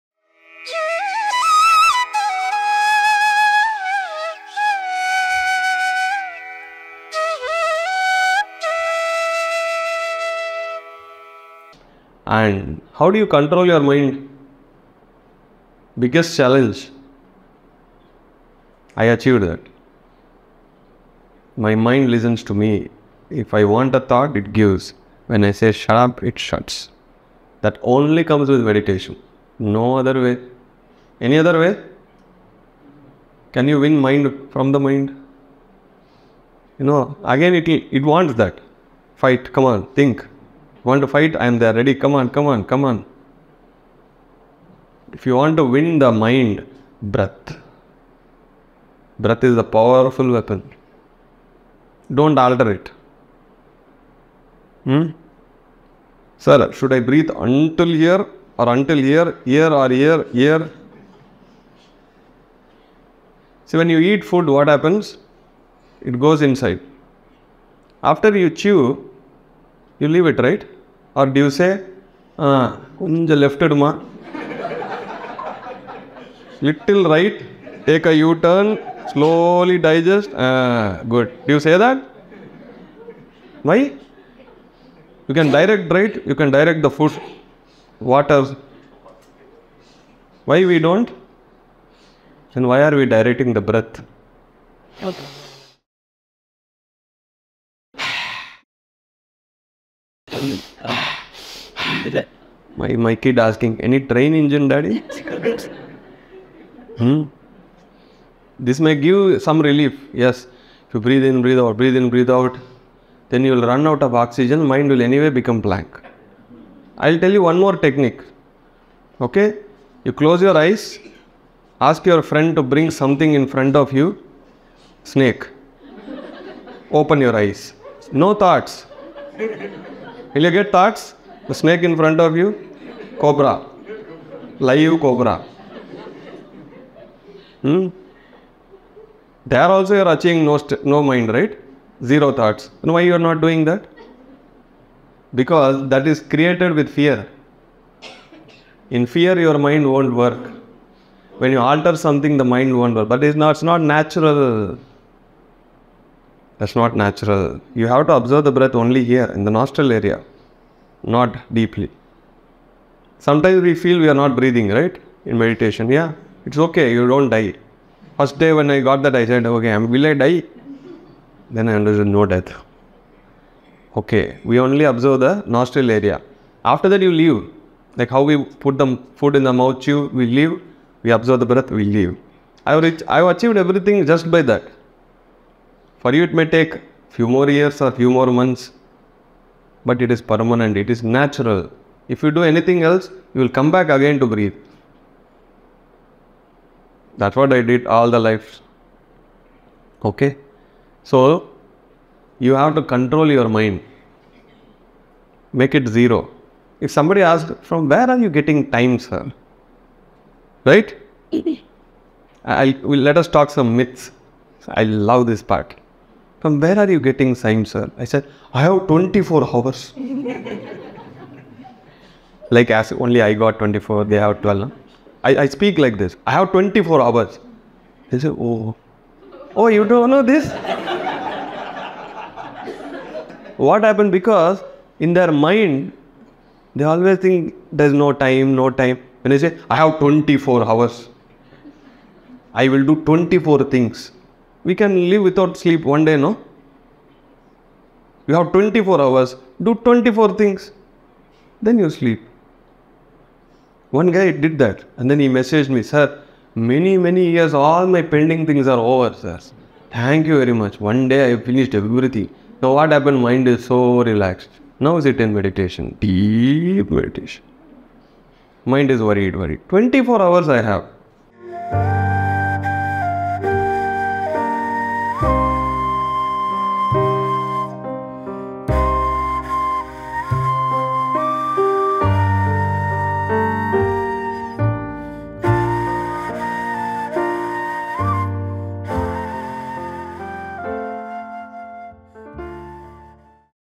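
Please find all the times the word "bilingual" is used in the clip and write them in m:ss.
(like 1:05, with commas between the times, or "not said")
not said.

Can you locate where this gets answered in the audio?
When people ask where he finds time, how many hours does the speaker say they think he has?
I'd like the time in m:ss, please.
3:44.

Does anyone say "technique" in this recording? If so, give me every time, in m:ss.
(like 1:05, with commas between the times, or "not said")
1:57.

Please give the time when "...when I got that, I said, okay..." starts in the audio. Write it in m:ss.
2:48.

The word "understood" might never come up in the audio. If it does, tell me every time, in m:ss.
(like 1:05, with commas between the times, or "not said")
2:51.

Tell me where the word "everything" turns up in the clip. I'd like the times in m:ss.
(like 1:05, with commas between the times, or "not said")
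3:03, 4:21.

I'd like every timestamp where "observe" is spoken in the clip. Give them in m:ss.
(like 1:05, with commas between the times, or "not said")
2:38, 2:54, 3:01.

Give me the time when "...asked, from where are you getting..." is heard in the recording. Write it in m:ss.
3:27.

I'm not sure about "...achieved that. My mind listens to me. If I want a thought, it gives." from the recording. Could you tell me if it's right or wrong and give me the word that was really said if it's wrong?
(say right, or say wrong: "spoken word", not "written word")
right.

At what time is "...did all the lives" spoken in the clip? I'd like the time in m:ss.
3:17.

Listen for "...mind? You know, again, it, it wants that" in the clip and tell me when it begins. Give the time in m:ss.
0:34.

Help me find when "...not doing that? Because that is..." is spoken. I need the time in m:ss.
2:23.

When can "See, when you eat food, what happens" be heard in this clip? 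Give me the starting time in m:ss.
1:03.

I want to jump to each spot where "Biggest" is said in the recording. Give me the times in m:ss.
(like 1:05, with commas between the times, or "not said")
0:16.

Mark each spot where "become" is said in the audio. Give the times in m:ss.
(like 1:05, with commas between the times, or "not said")
1:55.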